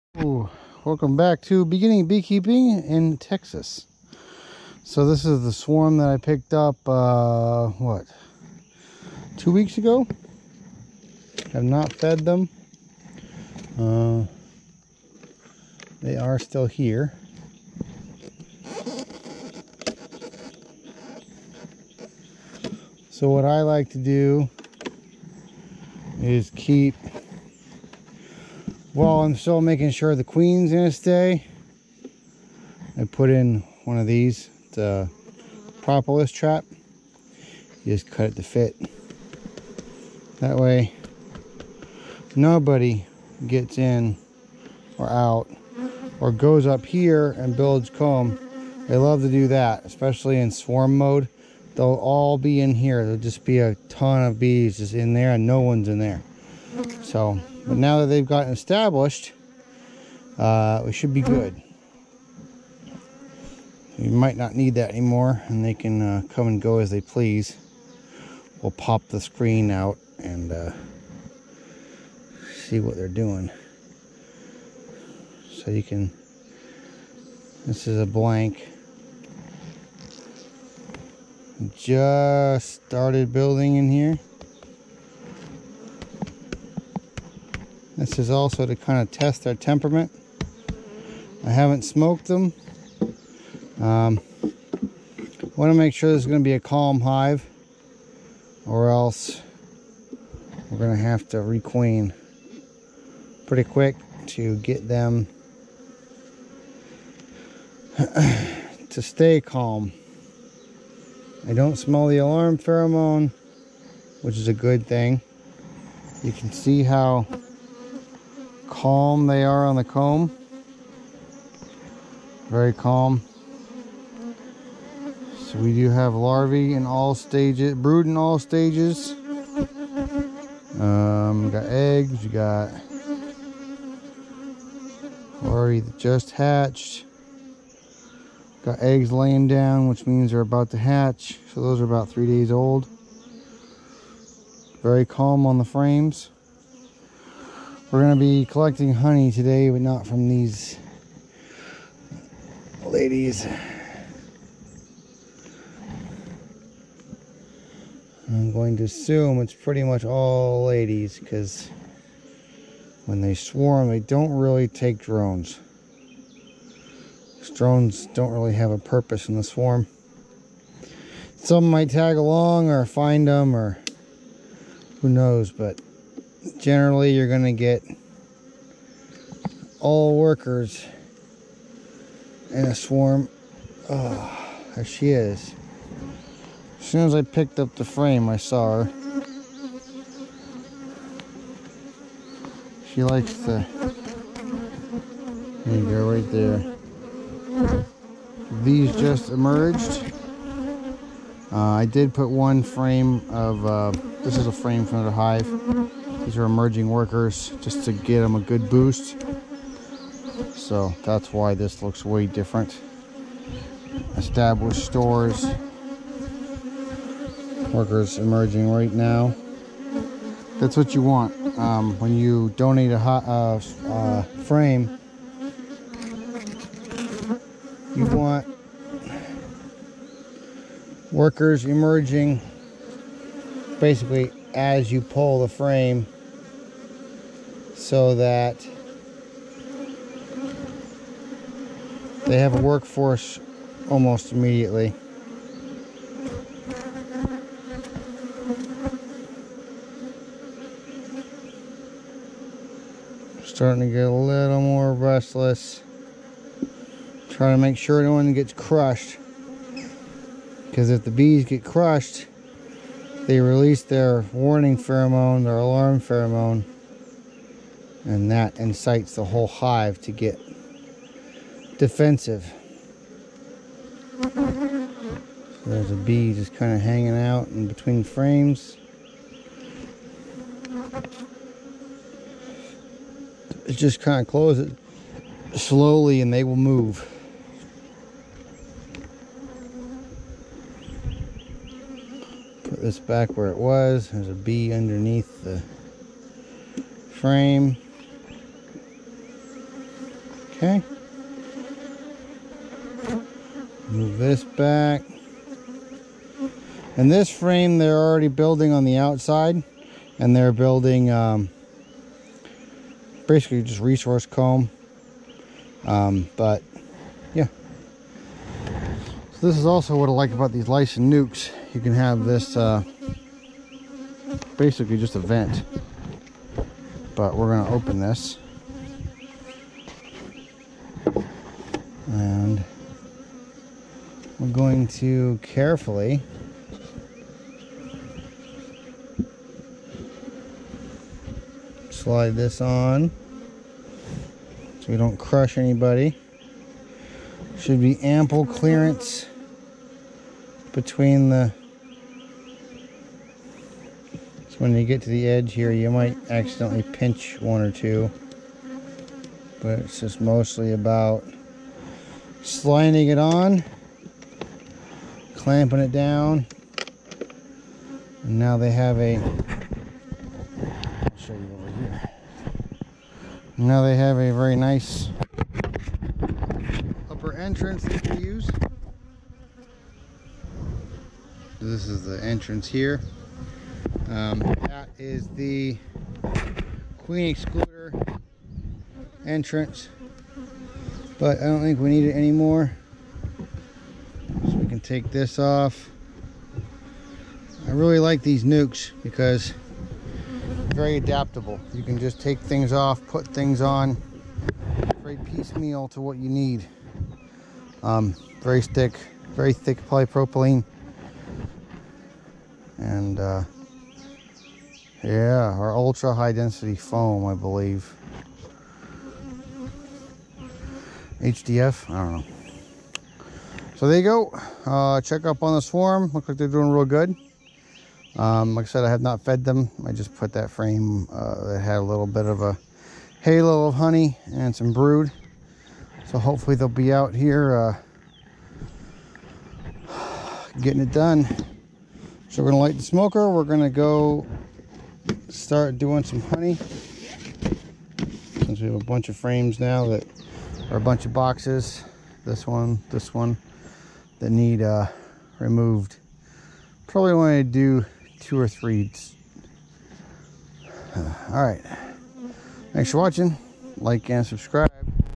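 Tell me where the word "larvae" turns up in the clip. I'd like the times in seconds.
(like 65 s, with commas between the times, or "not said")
126 s, 135 s.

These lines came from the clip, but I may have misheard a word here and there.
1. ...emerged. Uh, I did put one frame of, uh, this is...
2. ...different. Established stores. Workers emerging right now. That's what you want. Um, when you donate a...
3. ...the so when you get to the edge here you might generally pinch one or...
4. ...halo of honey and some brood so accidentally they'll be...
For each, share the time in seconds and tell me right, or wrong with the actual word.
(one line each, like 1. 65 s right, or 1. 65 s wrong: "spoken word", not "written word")
1. 199 s right
2. 212 s right
3. 351 s wrong: "accidentally", not "generally"
4. 433 s wrong: "hopefully", not "accidentally".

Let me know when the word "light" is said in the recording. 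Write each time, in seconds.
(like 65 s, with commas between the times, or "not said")
442 s.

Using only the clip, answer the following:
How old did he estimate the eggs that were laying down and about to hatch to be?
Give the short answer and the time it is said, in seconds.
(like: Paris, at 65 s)
3 days, at 142 s.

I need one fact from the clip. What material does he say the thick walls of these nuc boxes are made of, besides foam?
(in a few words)
polypropylene.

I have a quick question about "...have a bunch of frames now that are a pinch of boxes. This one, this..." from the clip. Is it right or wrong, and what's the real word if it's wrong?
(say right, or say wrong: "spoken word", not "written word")
wrong: "bunch", not "pinch".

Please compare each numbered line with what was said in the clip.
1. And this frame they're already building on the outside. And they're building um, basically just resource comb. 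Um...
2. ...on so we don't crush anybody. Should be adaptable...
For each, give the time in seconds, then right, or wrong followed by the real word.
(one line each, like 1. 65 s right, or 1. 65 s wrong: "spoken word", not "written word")
1. 306 s right
2. 342 s wrong: "ample", not "adaptable".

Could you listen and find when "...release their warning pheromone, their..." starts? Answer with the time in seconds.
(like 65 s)
263 s.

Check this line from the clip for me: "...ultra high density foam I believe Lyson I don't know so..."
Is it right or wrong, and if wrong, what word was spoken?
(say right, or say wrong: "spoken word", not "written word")
wrong: "HDF", not "Lyson".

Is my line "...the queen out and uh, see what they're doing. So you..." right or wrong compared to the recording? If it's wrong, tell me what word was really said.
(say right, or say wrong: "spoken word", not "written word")
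wrong: "screen", not "queen".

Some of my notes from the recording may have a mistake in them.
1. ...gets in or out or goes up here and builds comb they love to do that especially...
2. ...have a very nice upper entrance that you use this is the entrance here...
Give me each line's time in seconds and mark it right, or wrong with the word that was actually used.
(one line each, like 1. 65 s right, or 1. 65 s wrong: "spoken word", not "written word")
1. 43 s right
2. 373 s right.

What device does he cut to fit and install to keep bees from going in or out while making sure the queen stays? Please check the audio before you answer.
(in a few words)
propolis trap.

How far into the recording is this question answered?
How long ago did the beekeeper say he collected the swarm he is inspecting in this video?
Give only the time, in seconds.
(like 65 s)
9 s.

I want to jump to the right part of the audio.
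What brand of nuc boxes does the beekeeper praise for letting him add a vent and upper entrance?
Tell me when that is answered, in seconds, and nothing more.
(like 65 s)
320 s.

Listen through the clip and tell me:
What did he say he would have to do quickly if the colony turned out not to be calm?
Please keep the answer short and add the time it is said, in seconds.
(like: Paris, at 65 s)
requeen, at 101 s.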